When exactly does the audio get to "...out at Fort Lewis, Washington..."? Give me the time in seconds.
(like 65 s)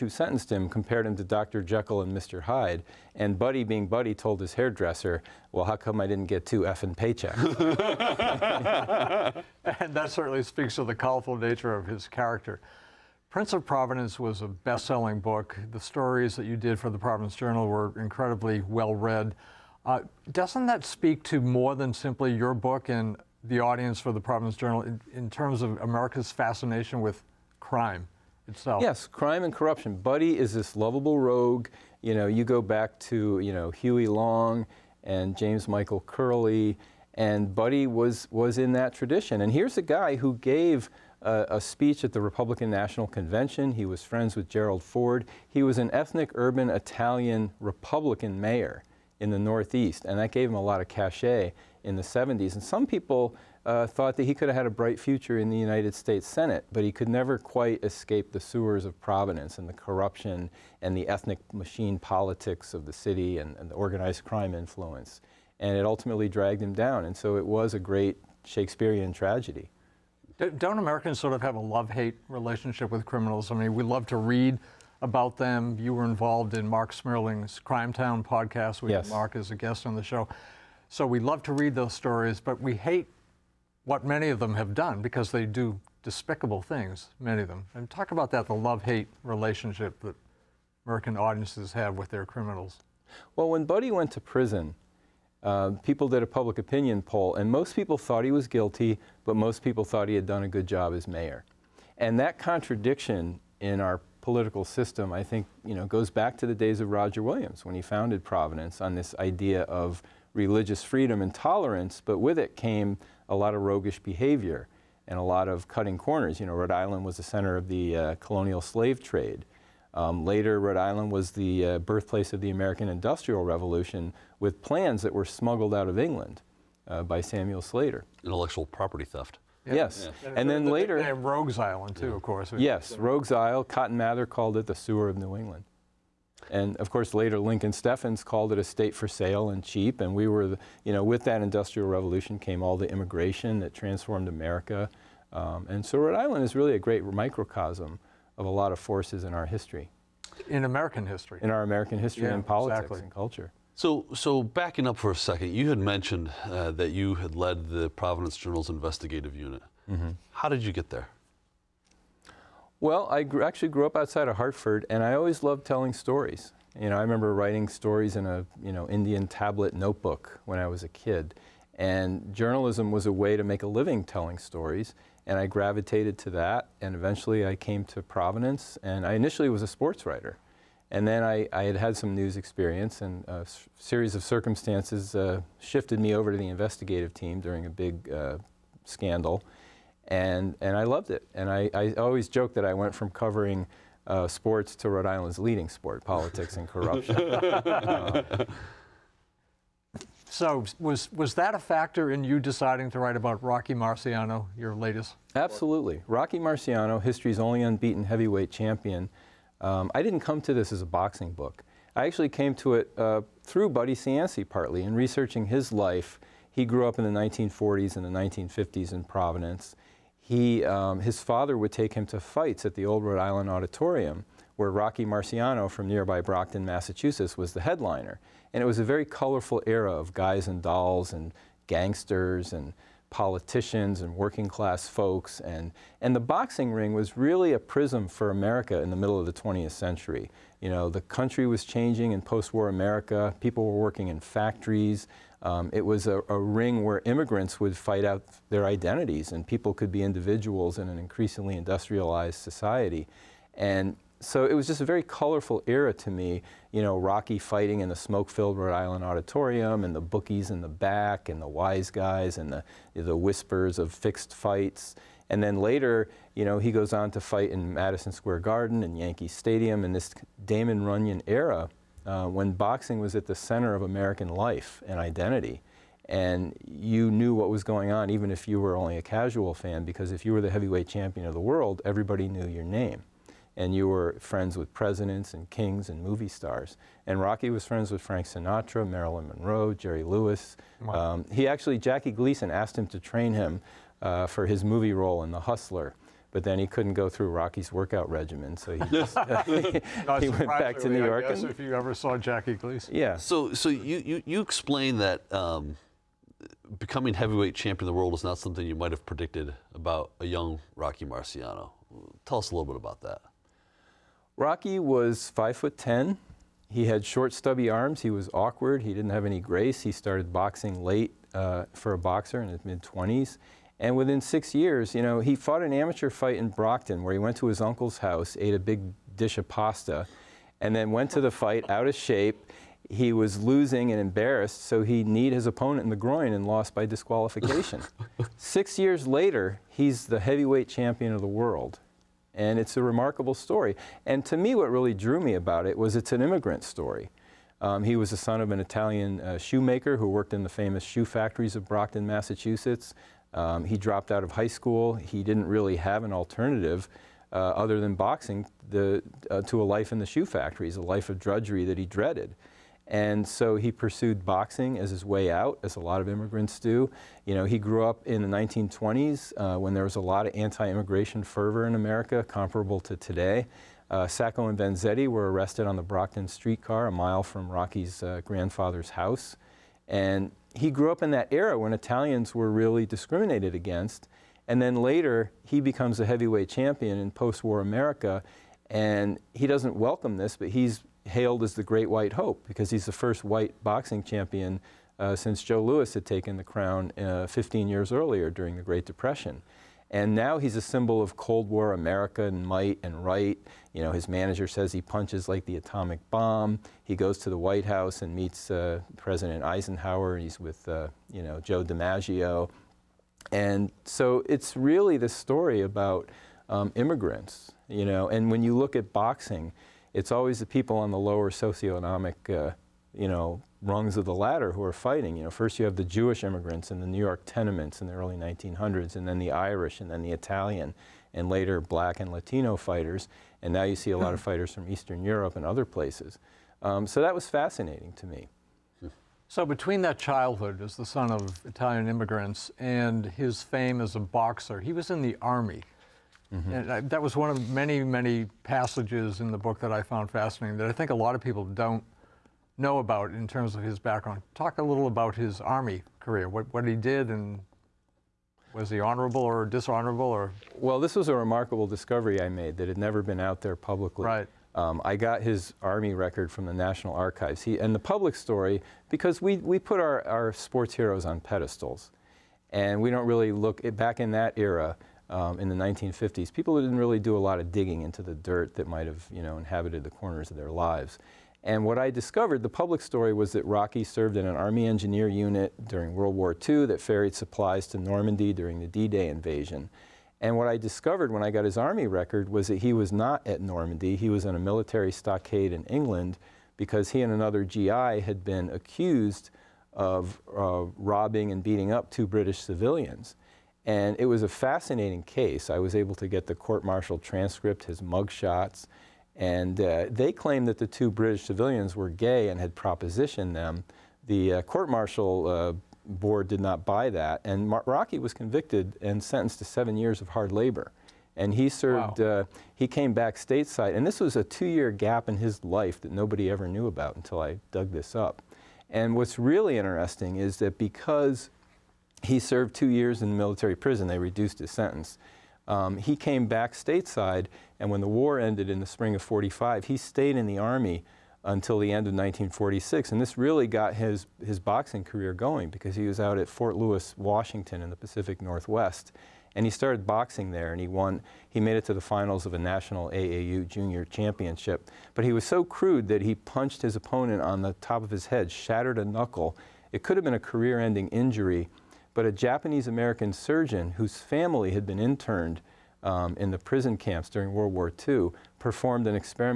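545 s.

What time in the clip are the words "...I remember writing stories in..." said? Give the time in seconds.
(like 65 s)
166 s.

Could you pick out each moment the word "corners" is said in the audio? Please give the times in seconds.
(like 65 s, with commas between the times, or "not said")
115 s, 479 s.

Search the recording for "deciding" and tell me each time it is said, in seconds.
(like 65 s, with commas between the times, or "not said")
202 s.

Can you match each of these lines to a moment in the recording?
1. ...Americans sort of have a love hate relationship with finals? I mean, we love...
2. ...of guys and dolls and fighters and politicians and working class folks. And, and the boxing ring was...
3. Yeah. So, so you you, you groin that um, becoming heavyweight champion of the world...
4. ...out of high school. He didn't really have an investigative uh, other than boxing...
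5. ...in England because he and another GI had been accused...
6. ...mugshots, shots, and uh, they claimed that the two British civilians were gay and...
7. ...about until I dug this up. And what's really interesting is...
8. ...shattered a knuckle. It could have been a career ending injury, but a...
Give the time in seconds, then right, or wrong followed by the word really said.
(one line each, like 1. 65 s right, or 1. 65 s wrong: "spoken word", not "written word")
1. 70 s wrong: "criminals", not "finals"
2. 229 s wrong: "gangsters", not "fighters"
3. 302 s wrong: "explain", not "groin"
4. 354 s wrong: "alternative", not "investigative"
5. 495 s right
6. 507 s right
7. 526 s right
8. 558 s right.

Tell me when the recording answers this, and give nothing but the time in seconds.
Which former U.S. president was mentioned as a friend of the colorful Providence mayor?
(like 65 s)
44 s.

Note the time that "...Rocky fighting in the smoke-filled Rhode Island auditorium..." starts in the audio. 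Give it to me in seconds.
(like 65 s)
256 s.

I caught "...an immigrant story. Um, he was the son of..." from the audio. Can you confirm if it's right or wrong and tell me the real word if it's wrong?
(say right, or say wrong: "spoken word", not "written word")
right.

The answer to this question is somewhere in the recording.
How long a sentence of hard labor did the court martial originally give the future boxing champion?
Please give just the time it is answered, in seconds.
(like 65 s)
519 s.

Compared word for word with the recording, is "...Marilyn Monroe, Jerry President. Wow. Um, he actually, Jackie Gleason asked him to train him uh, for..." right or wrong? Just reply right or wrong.
wrong.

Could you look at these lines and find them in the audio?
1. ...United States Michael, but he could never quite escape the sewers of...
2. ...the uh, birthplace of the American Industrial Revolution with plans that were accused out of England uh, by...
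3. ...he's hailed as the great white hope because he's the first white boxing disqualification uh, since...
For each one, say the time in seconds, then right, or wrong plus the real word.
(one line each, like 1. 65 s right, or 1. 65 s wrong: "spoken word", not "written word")
1. 55 s wrong: "Senate", not "Michael"
2. 121 s wrong: "smuggled", not "accused"
3. 390 s wrong: "champion", not "disqualification".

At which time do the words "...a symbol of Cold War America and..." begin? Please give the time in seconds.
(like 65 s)
400 s.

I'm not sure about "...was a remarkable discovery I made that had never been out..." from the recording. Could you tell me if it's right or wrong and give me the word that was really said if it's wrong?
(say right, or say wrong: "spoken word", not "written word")
right.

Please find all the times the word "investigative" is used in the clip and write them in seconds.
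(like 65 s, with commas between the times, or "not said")
158 s, 186 s.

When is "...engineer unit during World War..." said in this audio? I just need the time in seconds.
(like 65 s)
484 s.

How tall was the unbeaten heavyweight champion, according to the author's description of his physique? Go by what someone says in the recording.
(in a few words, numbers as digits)
5 foot 10.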